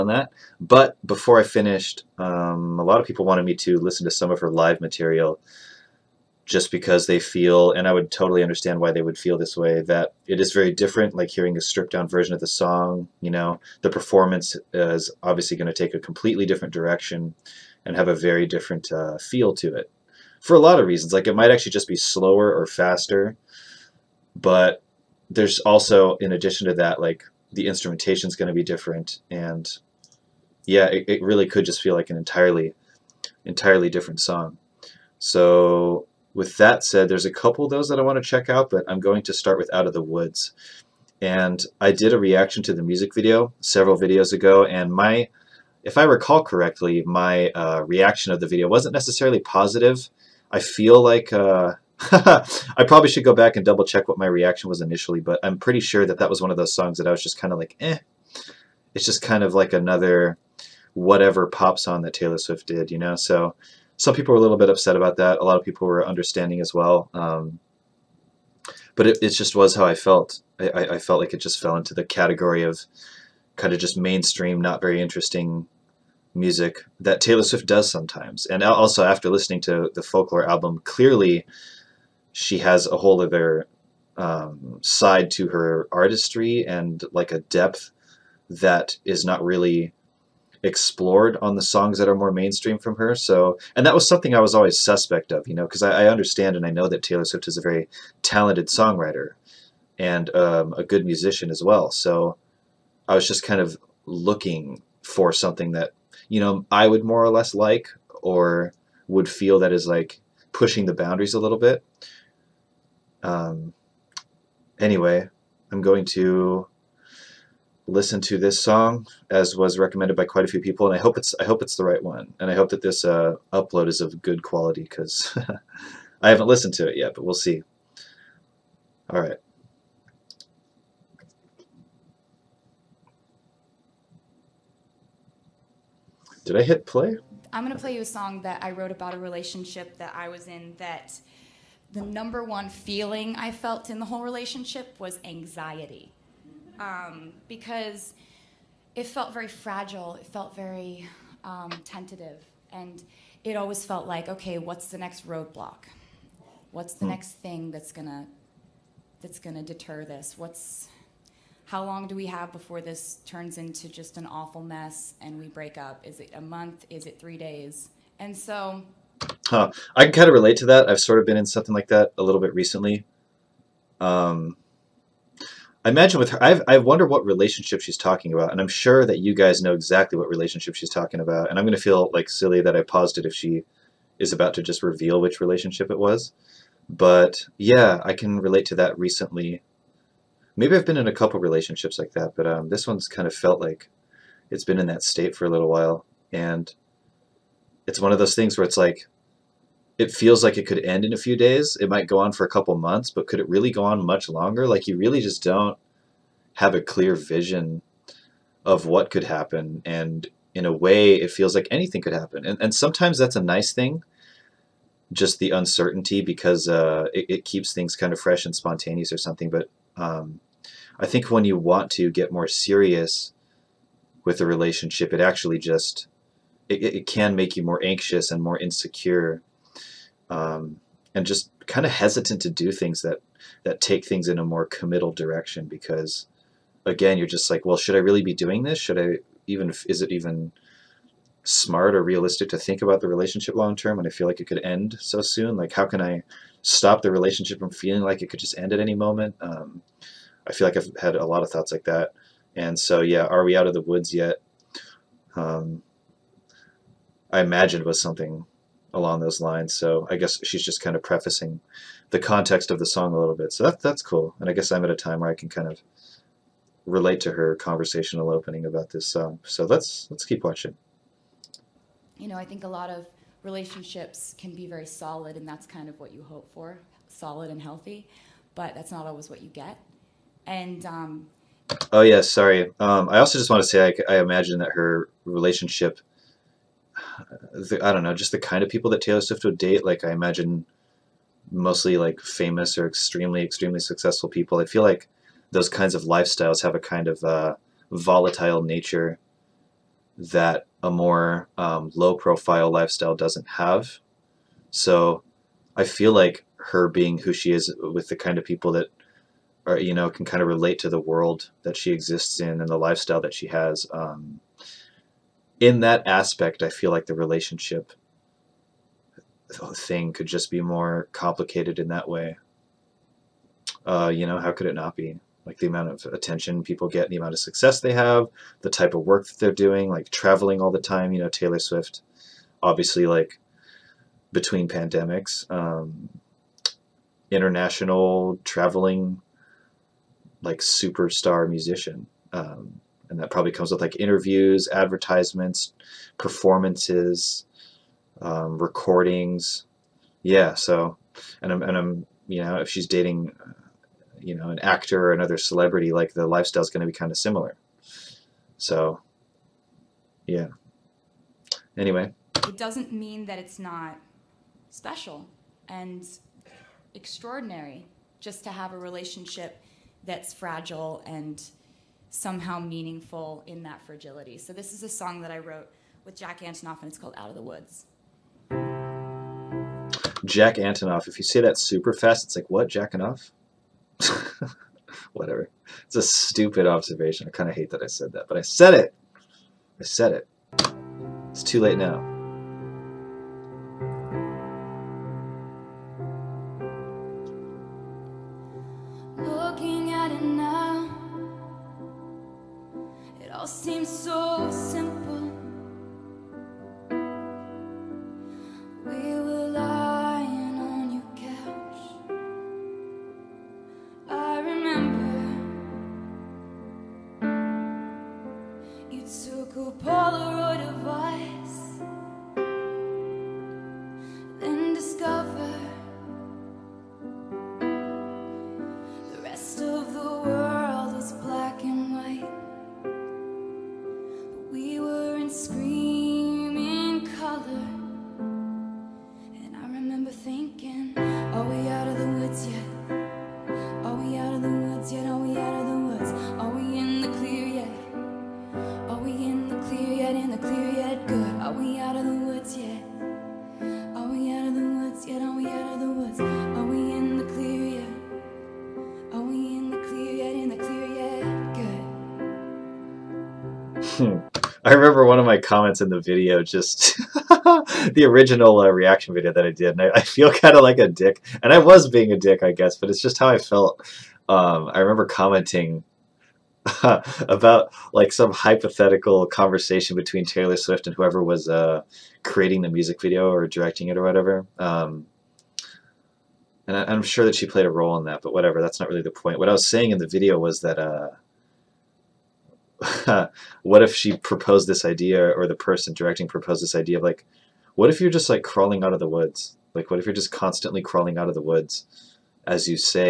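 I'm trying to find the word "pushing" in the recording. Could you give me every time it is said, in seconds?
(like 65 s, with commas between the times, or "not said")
110 s.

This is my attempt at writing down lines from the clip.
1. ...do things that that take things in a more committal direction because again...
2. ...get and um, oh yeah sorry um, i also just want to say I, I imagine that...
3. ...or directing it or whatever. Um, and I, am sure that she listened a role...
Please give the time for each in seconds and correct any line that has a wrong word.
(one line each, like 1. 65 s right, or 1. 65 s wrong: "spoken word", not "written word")
1. 232 s right
2. 279 s right
3. 483 s wrong: "played", not "listened".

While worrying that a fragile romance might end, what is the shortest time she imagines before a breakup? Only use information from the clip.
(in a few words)
three days.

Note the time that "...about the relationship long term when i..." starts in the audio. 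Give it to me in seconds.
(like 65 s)
242 s.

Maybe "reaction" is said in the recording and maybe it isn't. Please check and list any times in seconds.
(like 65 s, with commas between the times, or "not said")
42 s, 47 s, 54 s, 468 s.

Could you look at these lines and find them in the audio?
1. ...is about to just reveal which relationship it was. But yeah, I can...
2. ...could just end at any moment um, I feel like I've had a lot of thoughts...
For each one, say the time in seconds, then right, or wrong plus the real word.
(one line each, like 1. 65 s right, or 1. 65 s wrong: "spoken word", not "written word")
1. 184 s right
2. 248 s right.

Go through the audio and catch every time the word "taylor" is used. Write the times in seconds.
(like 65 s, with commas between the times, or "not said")
62 s, 77 s, 97 s, 289 s, 331 s, 480 s.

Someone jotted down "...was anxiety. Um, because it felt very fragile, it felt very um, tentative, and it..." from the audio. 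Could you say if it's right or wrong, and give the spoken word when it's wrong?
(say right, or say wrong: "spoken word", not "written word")
right.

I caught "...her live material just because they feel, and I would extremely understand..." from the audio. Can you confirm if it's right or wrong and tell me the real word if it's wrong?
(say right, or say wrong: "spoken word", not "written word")
wrong: "totally", not "extremely".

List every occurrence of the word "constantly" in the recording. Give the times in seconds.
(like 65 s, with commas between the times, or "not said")
500 s.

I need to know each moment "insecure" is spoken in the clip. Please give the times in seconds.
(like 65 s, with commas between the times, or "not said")
228 s.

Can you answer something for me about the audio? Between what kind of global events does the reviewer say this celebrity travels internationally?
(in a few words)
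pandemics.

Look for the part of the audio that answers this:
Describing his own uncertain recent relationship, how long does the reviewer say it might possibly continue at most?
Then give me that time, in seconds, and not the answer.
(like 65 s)
202 s.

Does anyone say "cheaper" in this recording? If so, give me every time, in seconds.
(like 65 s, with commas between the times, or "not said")
not said.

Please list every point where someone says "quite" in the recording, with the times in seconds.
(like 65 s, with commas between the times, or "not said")
120 s.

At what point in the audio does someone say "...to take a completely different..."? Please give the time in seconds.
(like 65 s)
15 s.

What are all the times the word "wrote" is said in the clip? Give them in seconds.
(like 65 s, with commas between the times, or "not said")
138 s, 375 s.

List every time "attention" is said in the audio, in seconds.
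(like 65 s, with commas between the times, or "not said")
326 s.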